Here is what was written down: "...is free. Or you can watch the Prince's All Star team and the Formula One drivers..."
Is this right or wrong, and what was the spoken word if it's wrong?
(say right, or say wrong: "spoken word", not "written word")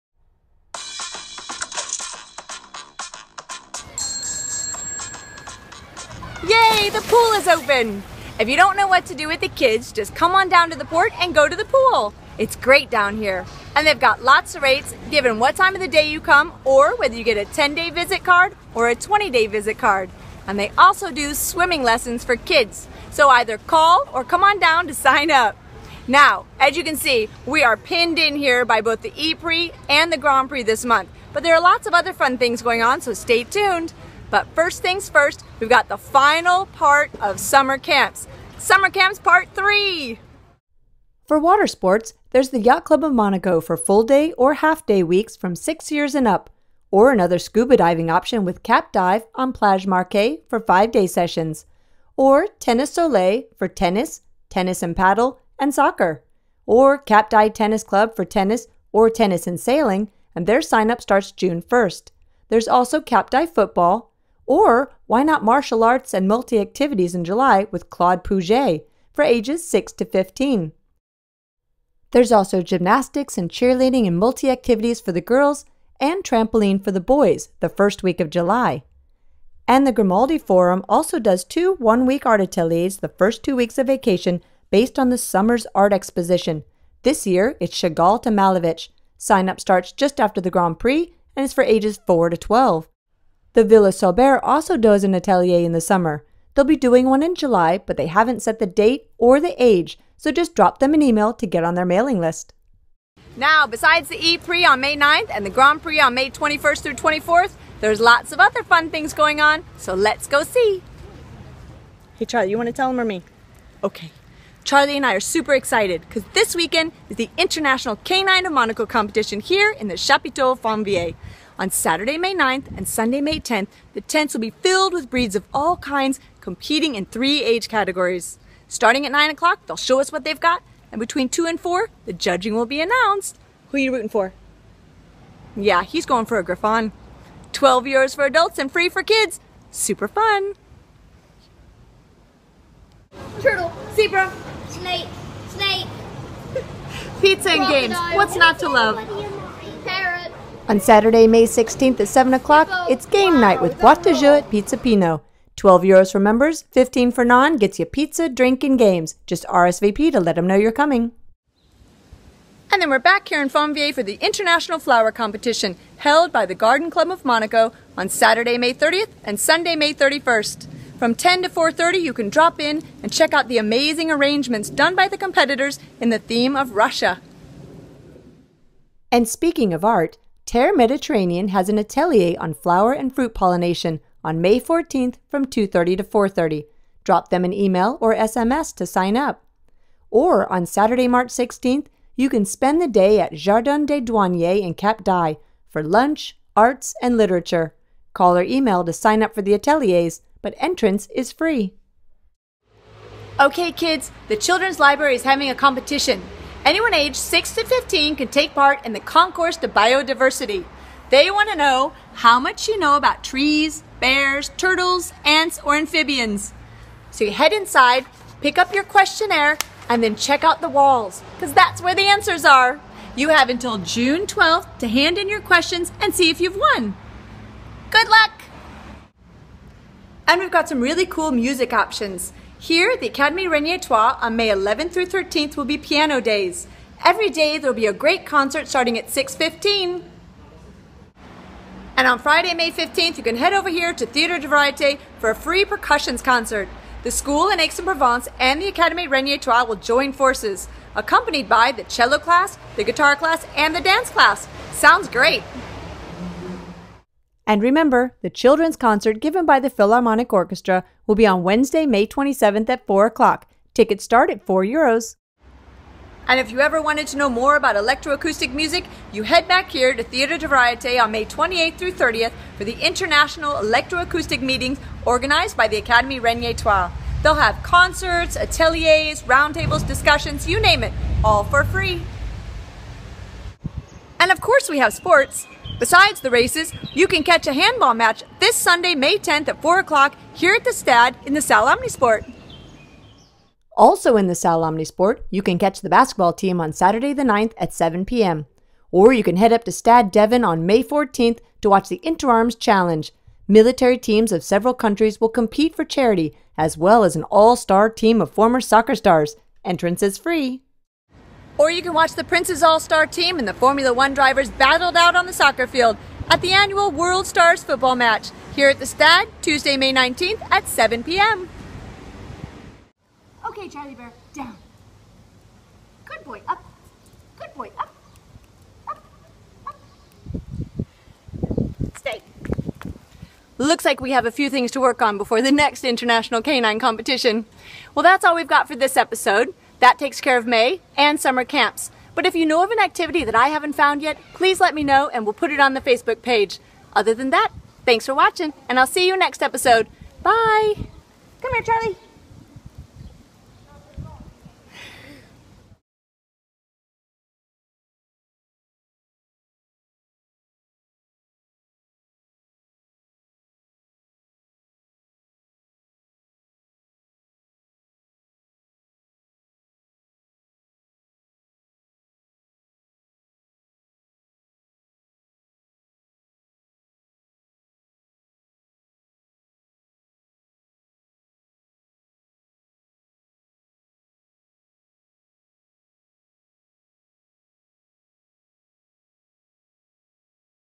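right.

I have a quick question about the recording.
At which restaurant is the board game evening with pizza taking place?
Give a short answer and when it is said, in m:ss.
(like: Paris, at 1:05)
Pizza Pino, at 2:34.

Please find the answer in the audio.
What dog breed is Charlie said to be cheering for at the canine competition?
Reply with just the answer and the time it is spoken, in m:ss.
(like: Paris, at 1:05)
Griffon, at 2:16.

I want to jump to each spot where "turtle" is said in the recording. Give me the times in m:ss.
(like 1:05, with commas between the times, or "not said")
2:23, 3:34.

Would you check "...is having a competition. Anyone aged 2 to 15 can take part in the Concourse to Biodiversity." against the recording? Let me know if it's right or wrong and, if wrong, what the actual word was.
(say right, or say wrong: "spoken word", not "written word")
wrong: "6", not "2".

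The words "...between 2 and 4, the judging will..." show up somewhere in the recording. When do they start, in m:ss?
2:10.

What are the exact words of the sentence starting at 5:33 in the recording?
Looks like we have a few things to work on before the next International Canine Competition.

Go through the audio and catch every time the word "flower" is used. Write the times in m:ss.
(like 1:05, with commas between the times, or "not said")
2:44, 3:02.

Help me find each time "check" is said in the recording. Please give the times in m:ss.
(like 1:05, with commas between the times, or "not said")
2:53, 3:40.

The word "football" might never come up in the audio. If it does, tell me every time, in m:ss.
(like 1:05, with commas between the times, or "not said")
1:03, 5:17.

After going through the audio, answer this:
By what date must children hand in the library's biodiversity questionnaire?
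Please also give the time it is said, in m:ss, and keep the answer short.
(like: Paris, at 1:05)
June 12th, at 3:43.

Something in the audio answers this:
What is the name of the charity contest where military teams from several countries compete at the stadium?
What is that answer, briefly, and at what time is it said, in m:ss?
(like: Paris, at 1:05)
Interarms Challenge, at 5:02.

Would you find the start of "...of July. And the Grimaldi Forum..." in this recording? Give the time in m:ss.
1:18.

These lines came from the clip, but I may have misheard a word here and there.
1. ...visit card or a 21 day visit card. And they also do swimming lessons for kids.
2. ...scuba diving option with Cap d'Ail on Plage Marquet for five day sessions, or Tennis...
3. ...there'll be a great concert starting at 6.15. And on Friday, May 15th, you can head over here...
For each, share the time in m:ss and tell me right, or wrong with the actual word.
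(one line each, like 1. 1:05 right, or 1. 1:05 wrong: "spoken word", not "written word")
1. 0:17 wrong: "20", not "21"
2. 0:47 right
3. 3:57 right.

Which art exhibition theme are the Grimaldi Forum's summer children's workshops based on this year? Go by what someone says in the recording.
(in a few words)
Chagall to Malevich.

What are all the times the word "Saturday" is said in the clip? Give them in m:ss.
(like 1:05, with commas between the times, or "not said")
2:01, 2:30, 2:48, 3:10, 4:56.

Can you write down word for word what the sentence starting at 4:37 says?
They'll have concerts, ateliers, roundtables, discussions, you name it, all for free.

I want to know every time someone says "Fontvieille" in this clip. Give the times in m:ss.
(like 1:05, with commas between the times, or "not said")
2:00, 2:43.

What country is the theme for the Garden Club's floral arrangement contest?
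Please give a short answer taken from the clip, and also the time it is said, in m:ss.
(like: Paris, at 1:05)
Russia, at 2:56.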